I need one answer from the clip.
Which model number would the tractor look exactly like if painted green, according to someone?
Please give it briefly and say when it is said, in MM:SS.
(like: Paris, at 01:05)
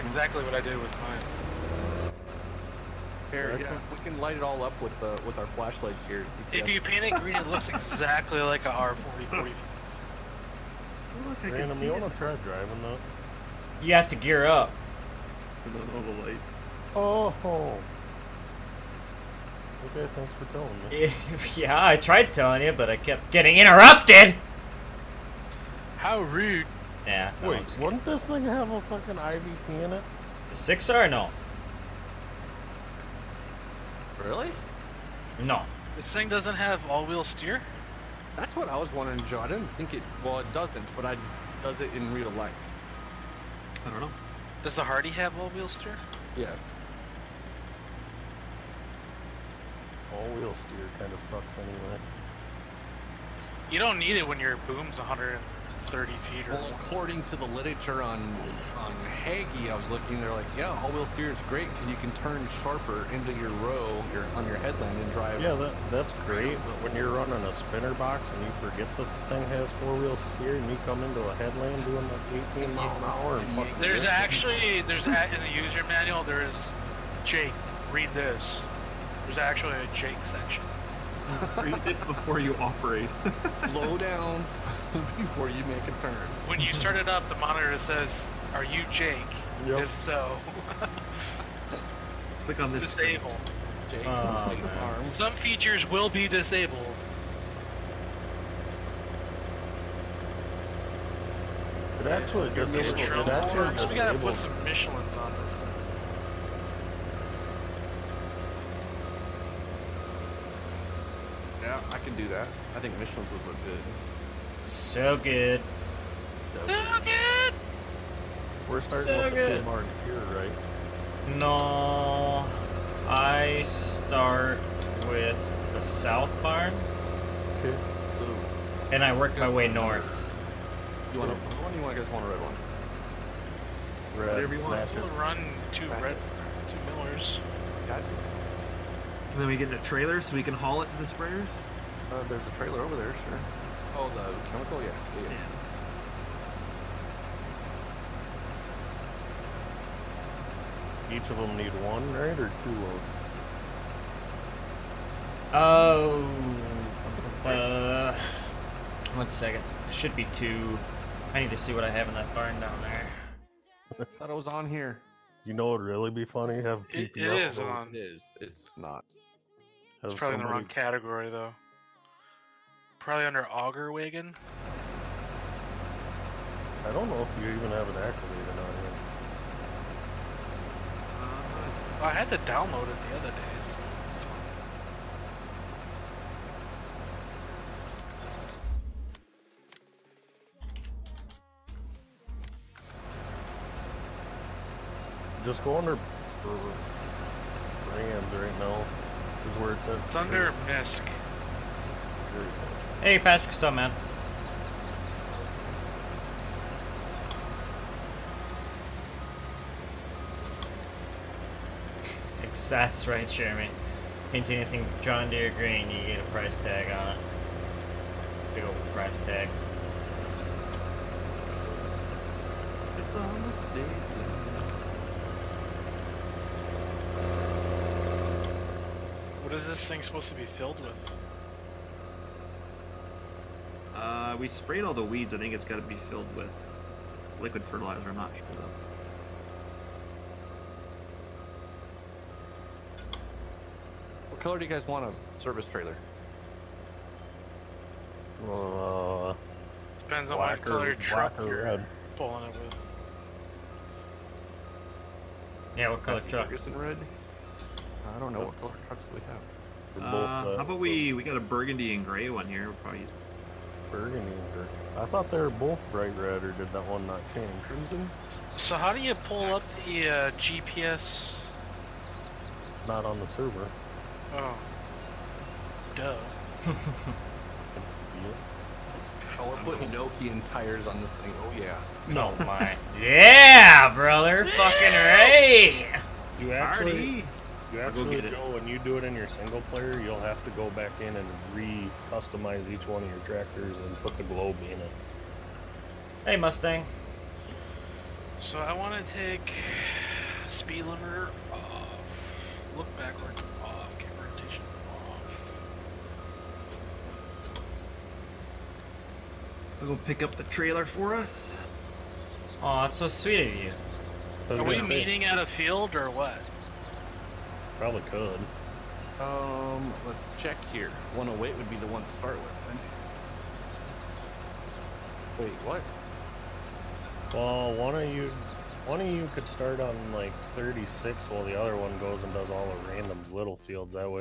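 R4045, at 00:08.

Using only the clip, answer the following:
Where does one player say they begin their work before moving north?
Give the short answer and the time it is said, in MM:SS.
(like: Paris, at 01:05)
the south barn, at 02:05.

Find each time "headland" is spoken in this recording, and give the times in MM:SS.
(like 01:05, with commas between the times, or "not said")
01:04, 01:11.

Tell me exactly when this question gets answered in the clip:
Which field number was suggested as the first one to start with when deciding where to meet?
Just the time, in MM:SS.
05:21.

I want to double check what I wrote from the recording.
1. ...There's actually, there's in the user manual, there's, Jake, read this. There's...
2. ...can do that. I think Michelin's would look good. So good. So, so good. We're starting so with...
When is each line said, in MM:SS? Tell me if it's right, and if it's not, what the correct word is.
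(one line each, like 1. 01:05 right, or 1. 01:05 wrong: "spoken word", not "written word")
1. 01:13 right
2. 01:51 right.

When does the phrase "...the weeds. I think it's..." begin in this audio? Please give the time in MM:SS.
03:54.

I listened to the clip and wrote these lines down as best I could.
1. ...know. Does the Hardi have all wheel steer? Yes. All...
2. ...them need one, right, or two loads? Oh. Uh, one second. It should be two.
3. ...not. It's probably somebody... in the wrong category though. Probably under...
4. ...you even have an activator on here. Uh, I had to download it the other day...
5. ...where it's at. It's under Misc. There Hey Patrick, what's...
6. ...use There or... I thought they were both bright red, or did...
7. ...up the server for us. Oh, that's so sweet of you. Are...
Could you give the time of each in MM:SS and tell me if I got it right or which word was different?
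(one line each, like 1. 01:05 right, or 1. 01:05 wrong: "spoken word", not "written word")
1. 00:44 right
2. 02:31 right
3. 02:48 right
4. 02:57 right
5. 03:19 right
6. 04:23 wrong: "Burgundy", not "There"
7. 05:10 wrong: "trailer", not "server".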